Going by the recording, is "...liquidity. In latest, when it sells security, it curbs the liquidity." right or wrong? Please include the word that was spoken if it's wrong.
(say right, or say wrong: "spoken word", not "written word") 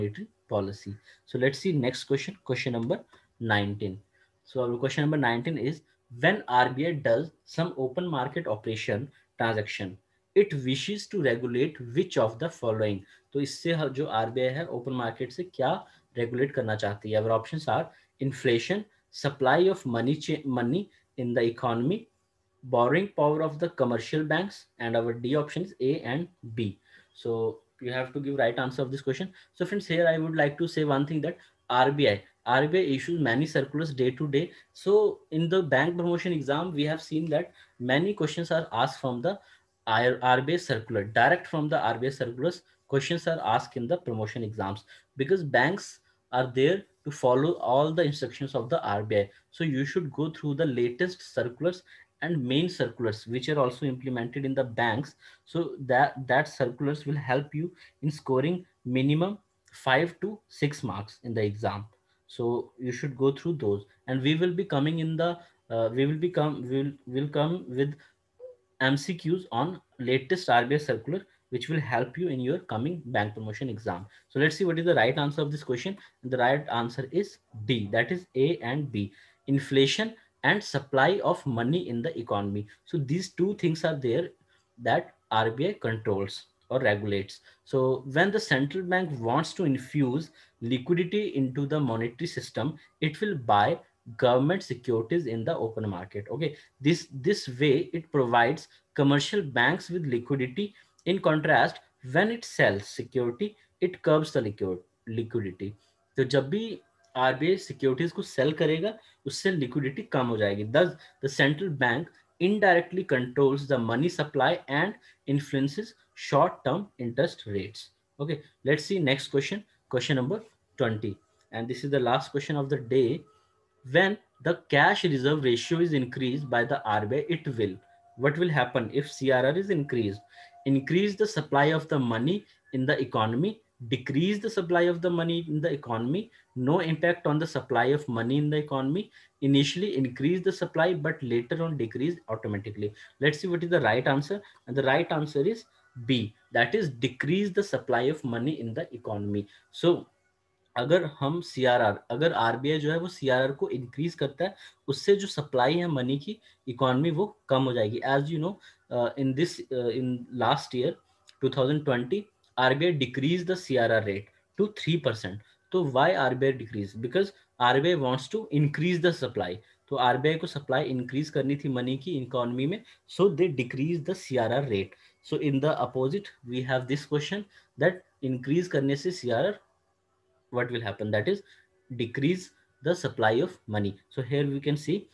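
wrong: "contrast", not "latest".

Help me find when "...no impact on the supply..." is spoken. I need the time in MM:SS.
02:16.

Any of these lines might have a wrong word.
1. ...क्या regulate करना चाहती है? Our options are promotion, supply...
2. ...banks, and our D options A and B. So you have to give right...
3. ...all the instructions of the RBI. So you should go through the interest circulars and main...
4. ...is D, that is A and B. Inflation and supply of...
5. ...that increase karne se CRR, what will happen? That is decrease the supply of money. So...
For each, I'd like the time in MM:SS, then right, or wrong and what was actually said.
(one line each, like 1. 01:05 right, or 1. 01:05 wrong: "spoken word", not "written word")
1. 00:15 wrong: "inflation", not "promotion"
2. 00:24 right
3. 00:47 wrong: "latest", not "interest"
4. 01:17 right
5. 02:57 right.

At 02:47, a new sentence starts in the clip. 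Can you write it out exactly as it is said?
Because RBI wants to increase the supply.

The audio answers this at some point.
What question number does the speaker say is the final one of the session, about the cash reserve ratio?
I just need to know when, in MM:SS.
02:00.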